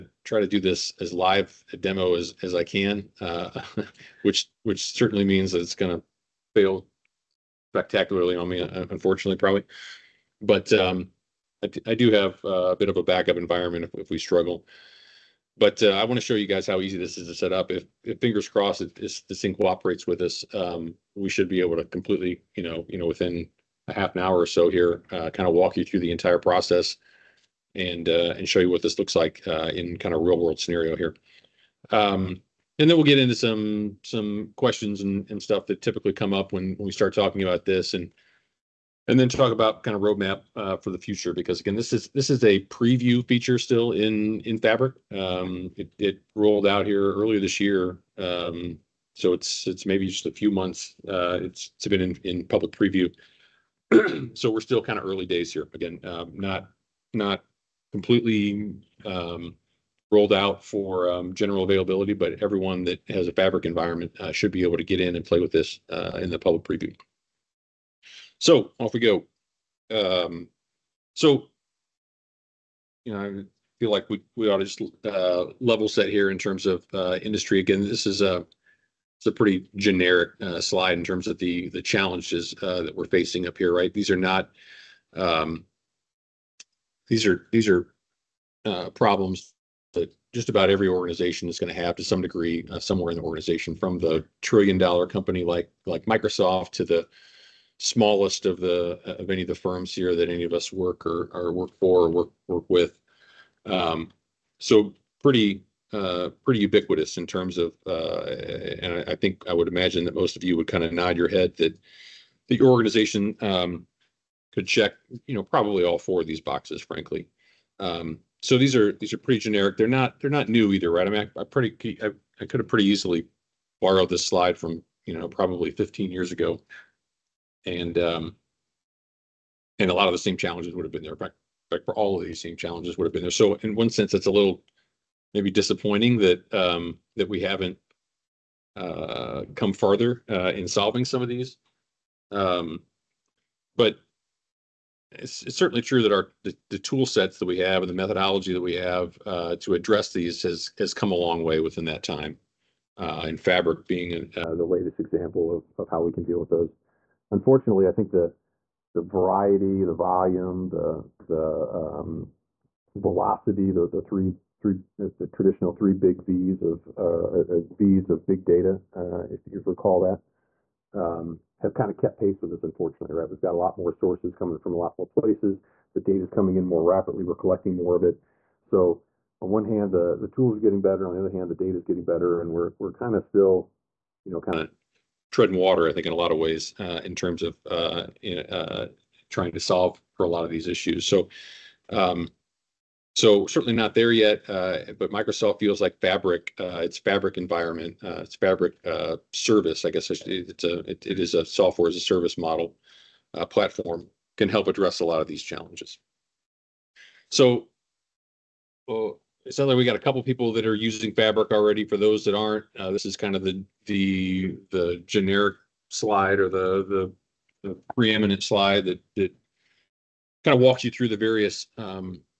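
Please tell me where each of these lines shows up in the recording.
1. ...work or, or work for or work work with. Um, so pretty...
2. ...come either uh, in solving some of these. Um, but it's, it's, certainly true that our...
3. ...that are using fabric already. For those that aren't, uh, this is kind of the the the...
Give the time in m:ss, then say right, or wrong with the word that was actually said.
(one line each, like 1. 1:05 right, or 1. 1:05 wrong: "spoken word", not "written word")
1. 1:40 right
2. 2:19 wrong: "farther", not "either"
3. 3:30 right.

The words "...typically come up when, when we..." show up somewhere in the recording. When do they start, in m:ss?
0:35.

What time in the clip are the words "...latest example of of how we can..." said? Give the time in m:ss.
2:34.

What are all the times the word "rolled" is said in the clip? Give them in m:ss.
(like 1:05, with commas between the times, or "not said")
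0:46, 1:00.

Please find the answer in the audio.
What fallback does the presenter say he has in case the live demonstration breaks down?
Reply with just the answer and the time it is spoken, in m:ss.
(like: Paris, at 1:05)
backup environment, at 0:13.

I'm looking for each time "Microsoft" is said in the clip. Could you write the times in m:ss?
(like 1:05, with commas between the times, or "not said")
1:36, 3:15.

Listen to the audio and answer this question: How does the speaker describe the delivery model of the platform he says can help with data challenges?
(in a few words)
software as a service.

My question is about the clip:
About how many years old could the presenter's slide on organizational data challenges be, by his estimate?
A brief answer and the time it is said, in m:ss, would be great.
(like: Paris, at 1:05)
15, at 2:05.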